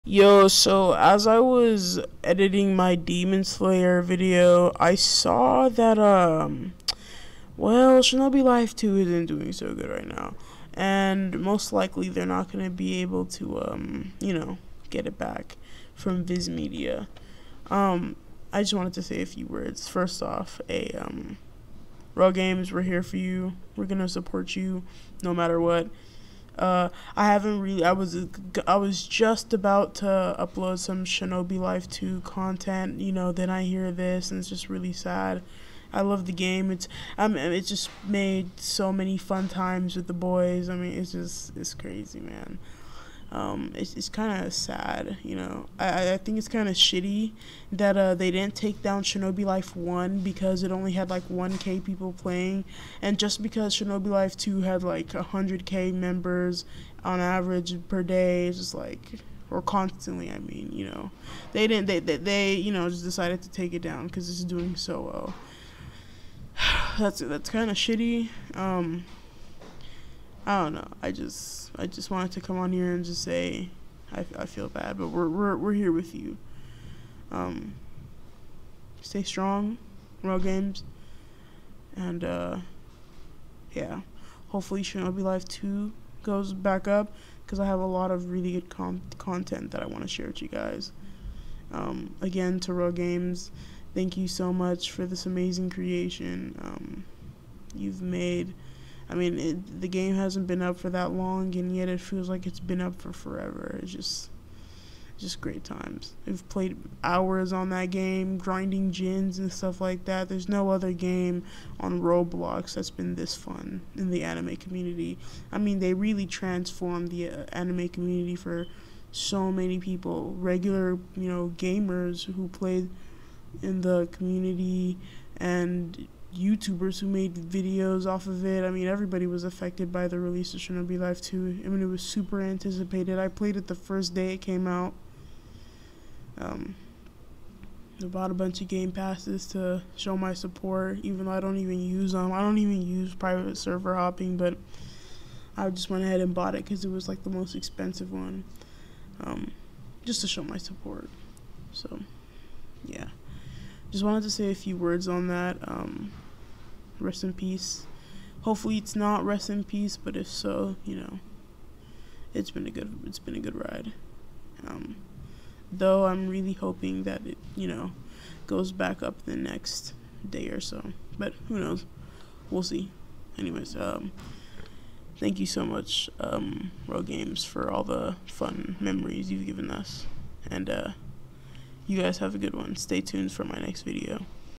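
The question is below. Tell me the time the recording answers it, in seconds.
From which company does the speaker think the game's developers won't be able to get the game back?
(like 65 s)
16 s.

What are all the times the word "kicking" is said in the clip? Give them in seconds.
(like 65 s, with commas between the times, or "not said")
not said.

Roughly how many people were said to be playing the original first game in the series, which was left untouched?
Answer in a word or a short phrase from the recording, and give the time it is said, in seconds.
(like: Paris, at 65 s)
1k, at 51 s.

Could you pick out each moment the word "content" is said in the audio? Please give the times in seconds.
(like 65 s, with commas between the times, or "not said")
32 s, 89 s.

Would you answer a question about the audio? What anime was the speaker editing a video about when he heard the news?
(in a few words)
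Demon Slayer.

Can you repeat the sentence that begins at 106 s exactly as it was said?
We've played hours on that game, grinding gins and stuff like that.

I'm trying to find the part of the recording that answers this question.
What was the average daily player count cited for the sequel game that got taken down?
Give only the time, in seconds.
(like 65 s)
55 s.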